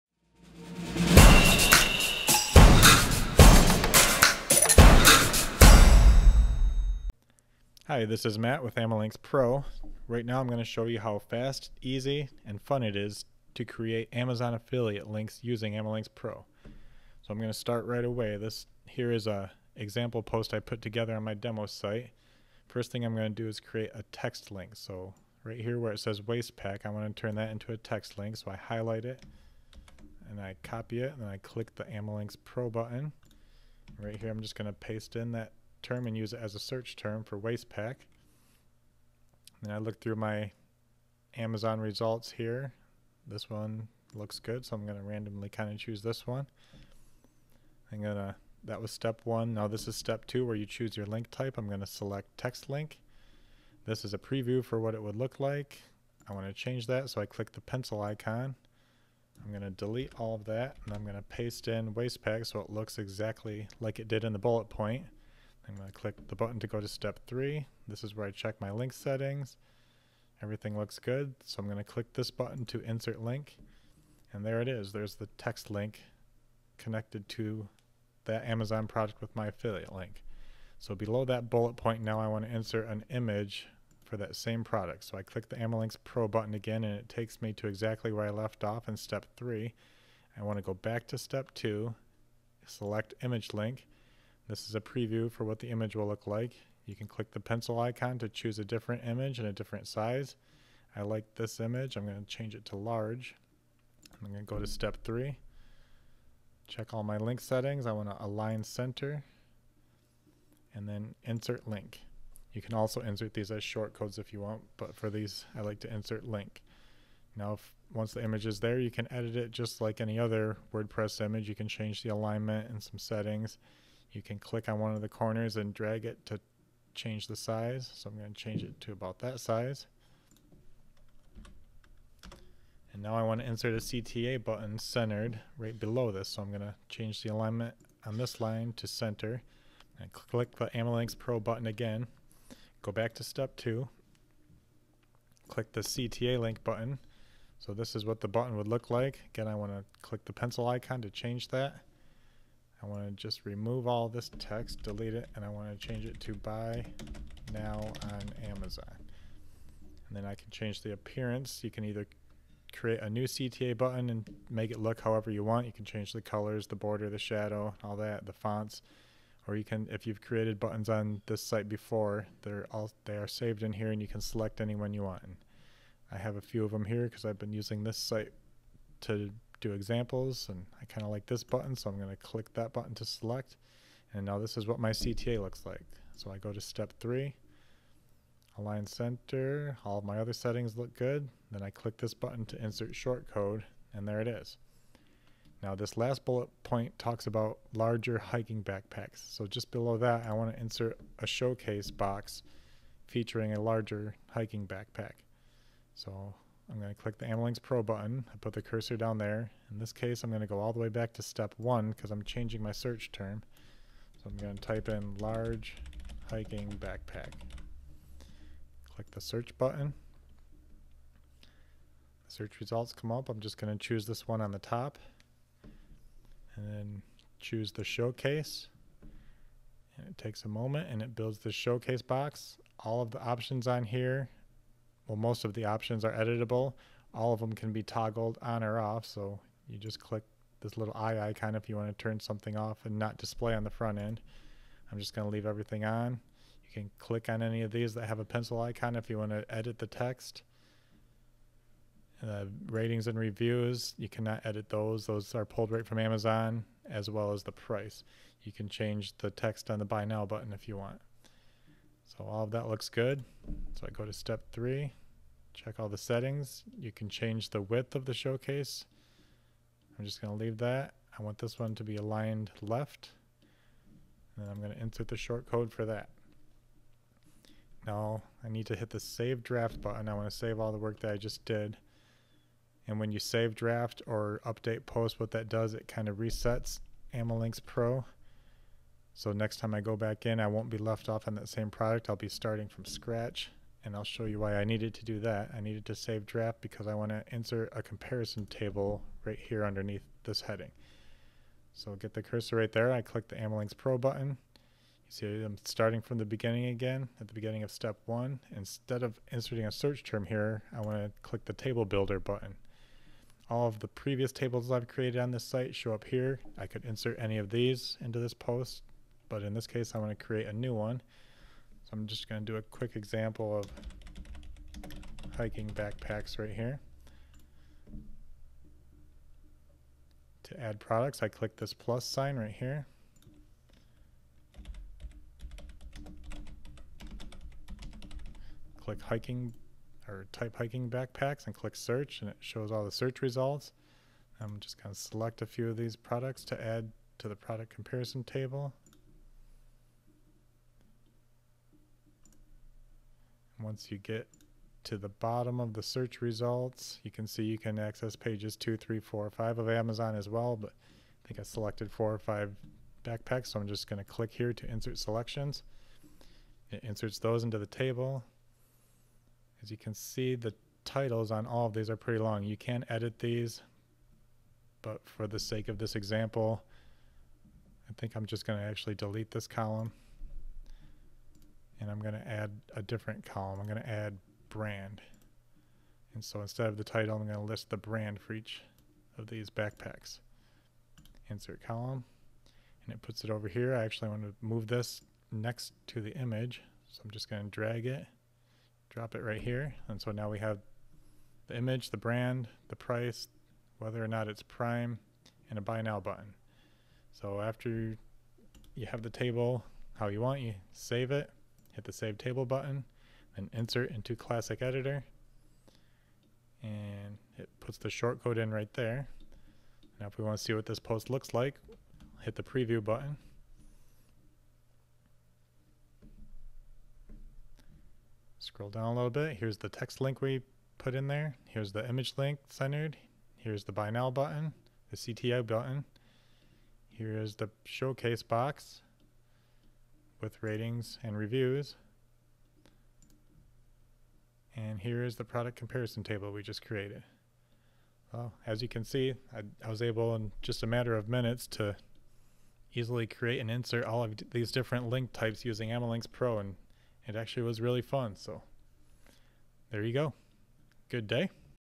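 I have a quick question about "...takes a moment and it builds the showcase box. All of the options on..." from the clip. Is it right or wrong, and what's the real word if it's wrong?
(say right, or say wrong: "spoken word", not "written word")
right.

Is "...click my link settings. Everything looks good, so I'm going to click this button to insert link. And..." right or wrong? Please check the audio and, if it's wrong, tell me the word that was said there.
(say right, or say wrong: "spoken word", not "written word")
wrong: "check", not "click".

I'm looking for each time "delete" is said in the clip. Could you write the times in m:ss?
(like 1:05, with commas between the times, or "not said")
0:59, 2:34, 6:18.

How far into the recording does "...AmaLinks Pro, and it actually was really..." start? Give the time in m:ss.
7:35.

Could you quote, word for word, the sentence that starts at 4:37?
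Now I need to hit the save draft button.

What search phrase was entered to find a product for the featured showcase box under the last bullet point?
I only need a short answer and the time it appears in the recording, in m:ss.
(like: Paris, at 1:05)
large hiking backpack, at 3:35.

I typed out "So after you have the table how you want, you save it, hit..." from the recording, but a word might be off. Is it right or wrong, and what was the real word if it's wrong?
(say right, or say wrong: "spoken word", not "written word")
right.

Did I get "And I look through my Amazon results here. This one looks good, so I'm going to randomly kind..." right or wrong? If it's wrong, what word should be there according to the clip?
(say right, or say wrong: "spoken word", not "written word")
right.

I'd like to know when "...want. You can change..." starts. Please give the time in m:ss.
2:45.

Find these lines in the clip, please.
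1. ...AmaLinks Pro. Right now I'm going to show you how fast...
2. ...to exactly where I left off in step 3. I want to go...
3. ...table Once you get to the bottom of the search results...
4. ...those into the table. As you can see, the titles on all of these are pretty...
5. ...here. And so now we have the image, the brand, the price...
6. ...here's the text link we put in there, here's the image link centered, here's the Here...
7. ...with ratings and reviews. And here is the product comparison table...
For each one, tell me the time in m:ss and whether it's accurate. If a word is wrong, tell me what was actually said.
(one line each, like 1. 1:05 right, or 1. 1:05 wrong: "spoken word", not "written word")
1. 0:08 right
2. 1:27 right
3. 5:48 right
4. 6:07 right
5. 6:39 right
6. 7:09 wrong: "Buy", not "Here"
7. 7:20 right.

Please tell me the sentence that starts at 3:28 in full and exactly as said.
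I put the cursor down there.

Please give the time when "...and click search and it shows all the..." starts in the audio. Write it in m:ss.
5:41.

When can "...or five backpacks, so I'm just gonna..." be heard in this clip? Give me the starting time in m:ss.
6:02.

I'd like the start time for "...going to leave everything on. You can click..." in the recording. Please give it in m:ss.
4:05.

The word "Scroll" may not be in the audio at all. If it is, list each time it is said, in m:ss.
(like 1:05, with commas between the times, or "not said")
7:08.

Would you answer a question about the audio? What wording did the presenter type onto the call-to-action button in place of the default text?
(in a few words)
buy now on Amazon.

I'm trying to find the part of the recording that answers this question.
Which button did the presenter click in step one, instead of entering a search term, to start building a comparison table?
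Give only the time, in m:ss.
5:11.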